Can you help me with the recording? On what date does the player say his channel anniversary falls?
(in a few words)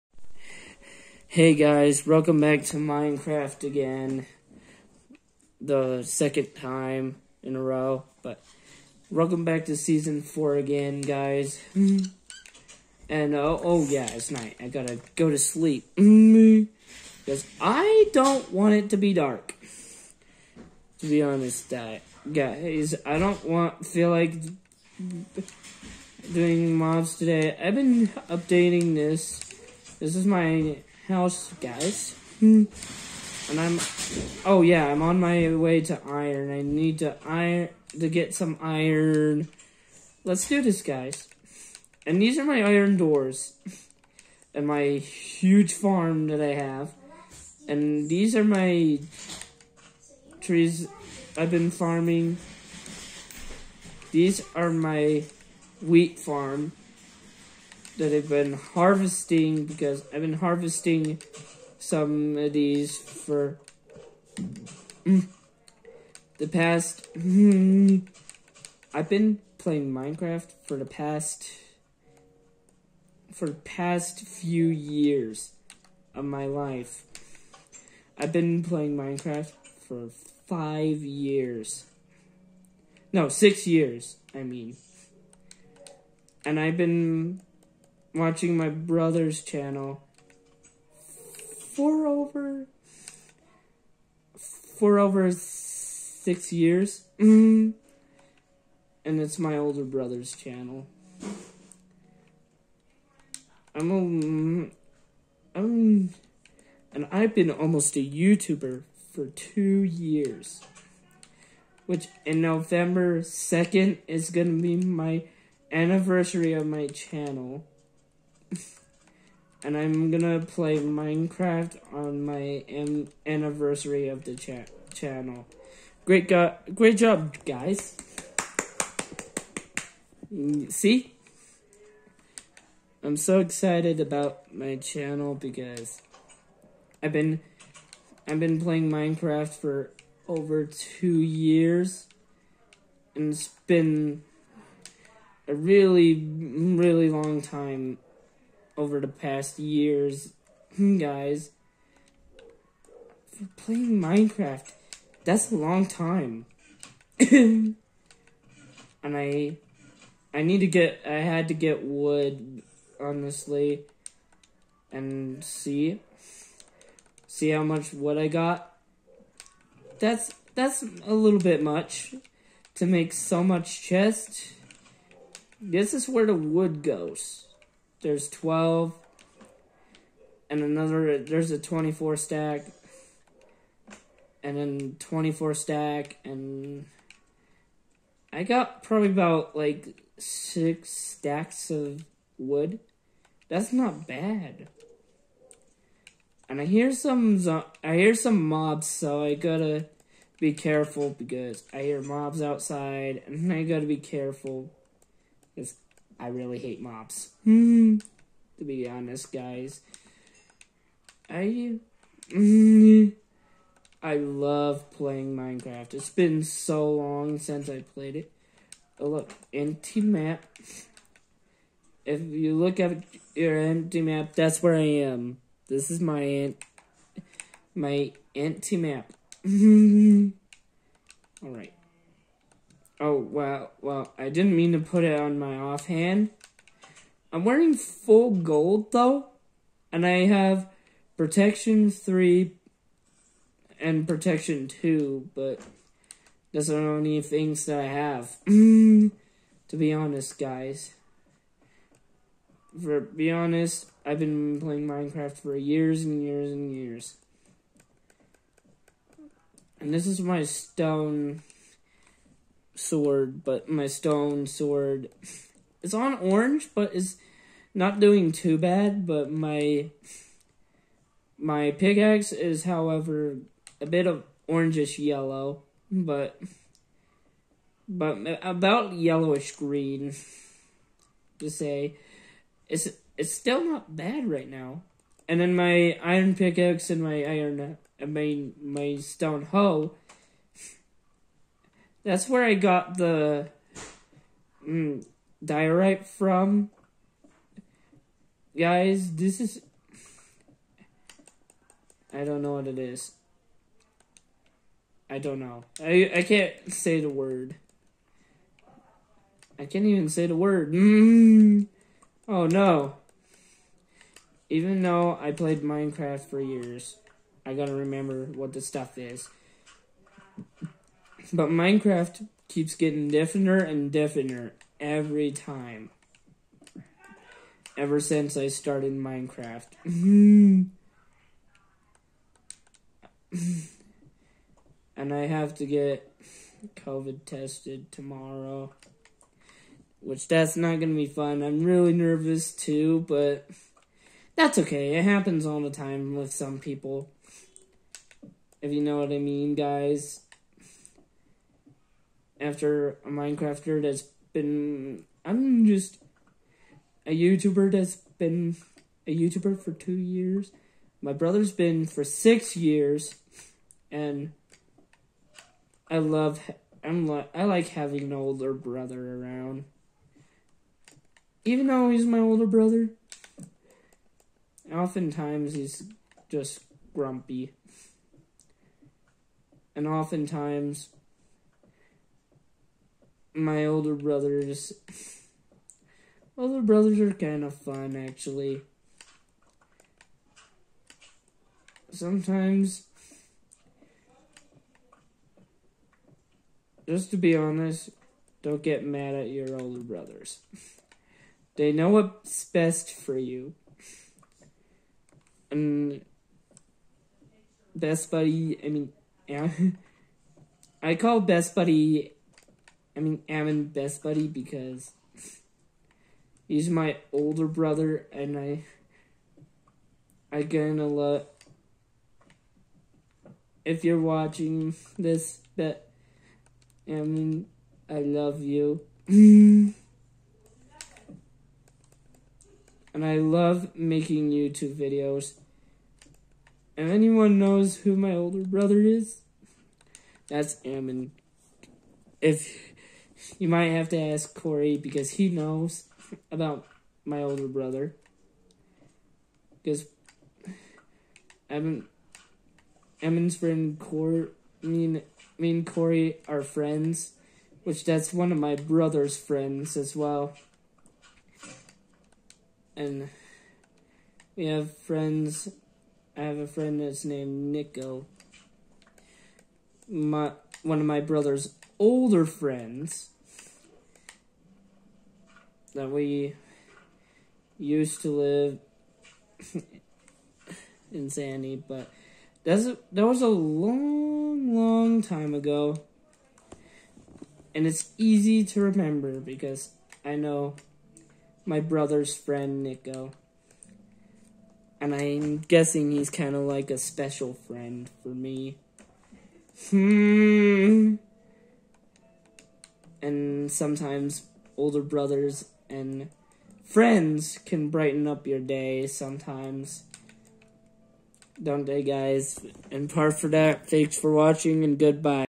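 November 2nd.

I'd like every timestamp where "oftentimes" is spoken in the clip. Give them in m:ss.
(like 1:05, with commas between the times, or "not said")
6:14, 6:19.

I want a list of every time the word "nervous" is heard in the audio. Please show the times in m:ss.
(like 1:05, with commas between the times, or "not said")
5:41.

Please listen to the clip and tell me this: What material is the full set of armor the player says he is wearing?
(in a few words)
Gold.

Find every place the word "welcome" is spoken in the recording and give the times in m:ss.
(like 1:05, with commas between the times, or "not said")
0:02, 0:09.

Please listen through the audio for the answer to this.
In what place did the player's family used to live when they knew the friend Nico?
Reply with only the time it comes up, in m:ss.
8:01.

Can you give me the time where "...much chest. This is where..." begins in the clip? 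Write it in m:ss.
2:53.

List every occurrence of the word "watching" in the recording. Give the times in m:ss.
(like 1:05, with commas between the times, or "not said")
1:28, 7:04, 8:34.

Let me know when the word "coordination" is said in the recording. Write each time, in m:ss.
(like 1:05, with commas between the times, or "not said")
not said.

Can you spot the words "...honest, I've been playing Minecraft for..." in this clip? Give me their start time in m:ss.
4:13.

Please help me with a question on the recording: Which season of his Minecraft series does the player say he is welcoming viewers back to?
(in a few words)
Season 4.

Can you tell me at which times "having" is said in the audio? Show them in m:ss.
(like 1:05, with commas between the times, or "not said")
6:07.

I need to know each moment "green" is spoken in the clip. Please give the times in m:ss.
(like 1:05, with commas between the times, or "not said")
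4:39.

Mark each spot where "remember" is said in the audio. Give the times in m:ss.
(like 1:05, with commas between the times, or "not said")
5:17, 8:08.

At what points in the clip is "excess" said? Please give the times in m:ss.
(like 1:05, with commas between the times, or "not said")
not said.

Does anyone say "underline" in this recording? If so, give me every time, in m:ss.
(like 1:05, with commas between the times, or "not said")
not said.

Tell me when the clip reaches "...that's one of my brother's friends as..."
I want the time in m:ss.
7:37.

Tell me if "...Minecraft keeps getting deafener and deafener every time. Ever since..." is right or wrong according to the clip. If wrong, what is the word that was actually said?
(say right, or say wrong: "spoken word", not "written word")
right.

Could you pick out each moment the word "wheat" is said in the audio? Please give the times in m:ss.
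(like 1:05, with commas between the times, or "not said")
0:55.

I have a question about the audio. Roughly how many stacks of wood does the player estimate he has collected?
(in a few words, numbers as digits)
6.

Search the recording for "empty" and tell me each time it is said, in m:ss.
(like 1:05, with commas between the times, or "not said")
3:39, 3:43, 3:48.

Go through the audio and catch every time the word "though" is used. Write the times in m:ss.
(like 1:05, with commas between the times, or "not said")
3:58, 5:14, 6:11.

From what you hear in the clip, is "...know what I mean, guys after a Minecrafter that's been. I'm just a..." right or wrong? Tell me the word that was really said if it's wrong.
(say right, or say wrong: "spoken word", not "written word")
right.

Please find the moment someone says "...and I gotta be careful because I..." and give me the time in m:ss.
3:23.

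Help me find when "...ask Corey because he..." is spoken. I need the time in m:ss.
7:23.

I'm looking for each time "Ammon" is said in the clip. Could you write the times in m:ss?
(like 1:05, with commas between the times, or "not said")
6:53, 7:06, 7:20.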